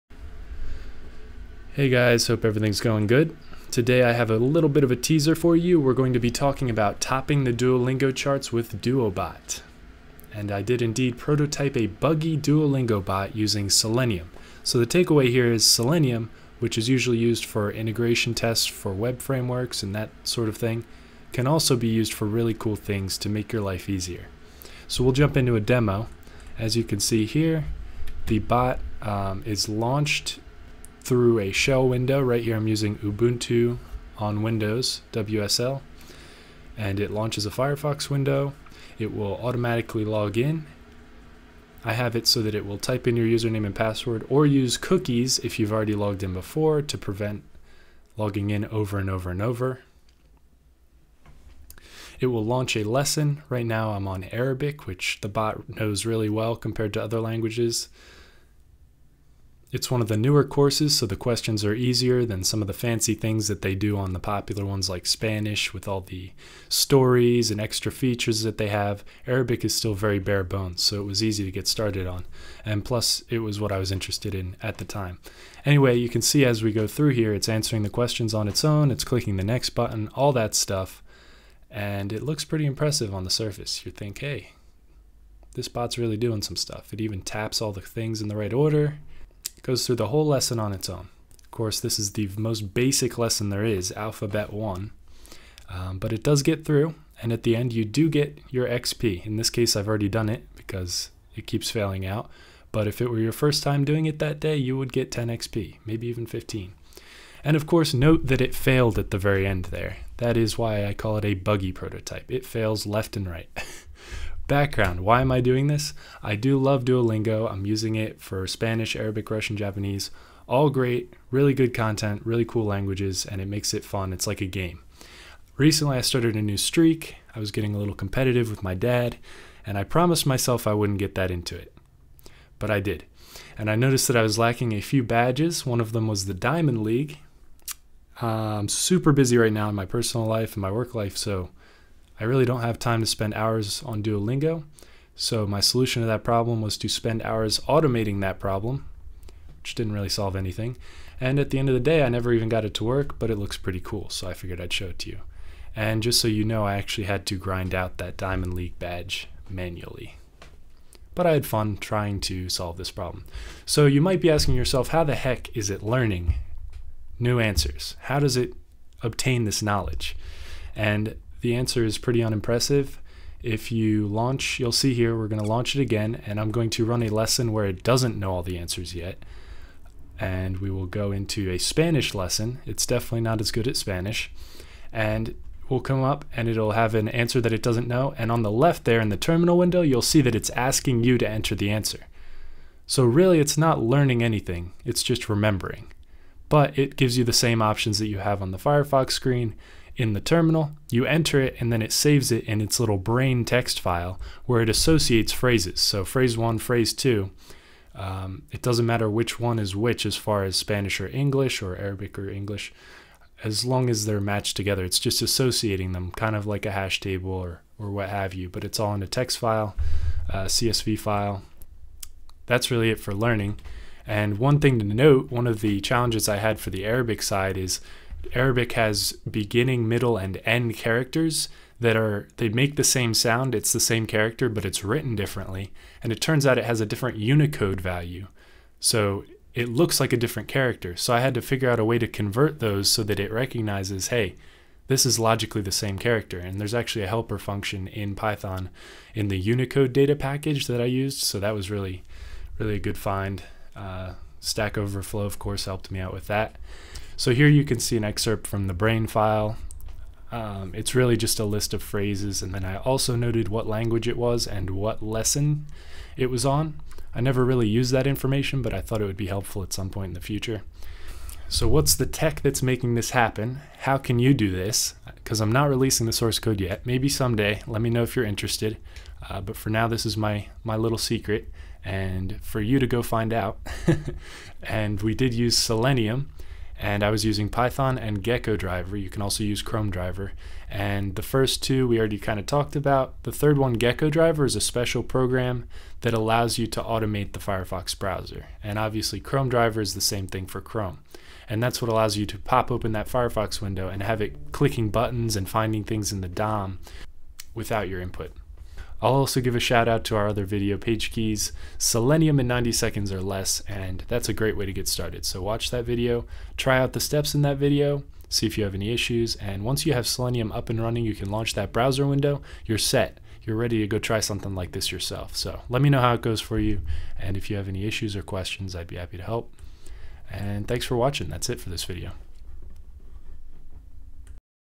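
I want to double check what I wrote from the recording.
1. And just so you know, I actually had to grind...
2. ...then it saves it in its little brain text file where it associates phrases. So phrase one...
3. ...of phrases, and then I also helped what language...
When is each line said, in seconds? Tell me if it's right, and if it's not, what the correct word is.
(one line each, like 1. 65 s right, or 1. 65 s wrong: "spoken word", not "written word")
1. 155 s right
2. 201 s right
3. 261 s wrong: "noted", not "helped".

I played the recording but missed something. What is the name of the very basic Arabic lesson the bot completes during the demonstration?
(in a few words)
Alphabet 1.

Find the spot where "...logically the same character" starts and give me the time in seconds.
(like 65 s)
245 s.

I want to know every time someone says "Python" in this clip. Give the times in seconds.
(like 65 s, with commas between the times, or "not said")
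248 s, 287 s.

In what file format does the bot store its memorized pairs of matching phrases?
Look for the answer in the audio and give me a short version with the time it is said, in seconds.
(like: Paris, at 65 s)
CSV, at 220 s.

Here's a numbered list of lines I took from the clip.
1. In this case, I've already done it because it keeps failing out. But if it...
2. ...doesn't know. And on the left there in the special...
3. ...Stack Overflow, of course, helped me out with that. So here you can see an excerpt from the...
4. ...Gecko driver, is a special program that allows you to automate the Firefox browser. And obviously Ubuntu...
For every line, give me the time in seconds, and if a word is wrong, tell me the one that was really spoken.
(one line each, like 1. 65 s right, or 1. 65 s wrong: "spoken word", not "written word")
1. 99 s right
2. 187 s wrong: "terminal", not "special"
3. 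254 s right
4. 293 s wrong: "Chrome", not "Ubuntu".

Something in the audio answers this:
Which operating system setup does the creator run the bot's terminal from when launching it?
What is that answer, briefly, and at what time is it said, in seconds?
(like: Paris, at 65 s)
Ubuntu on Windows WSL, at 32 s.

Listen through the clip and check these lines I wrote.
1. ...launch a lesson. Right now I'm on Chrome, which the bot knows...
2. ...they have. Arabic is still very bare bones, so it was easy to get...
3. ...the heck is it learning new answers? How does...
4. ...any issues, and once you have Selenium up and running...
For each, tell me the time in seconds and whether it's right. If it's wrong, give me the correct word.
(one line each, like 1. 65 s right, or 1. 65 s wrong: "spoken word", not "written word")
1. 52 s wrong: "Arabic", not "Chrome"
2. 68 s right
3. 165 s right
4. 318 s right.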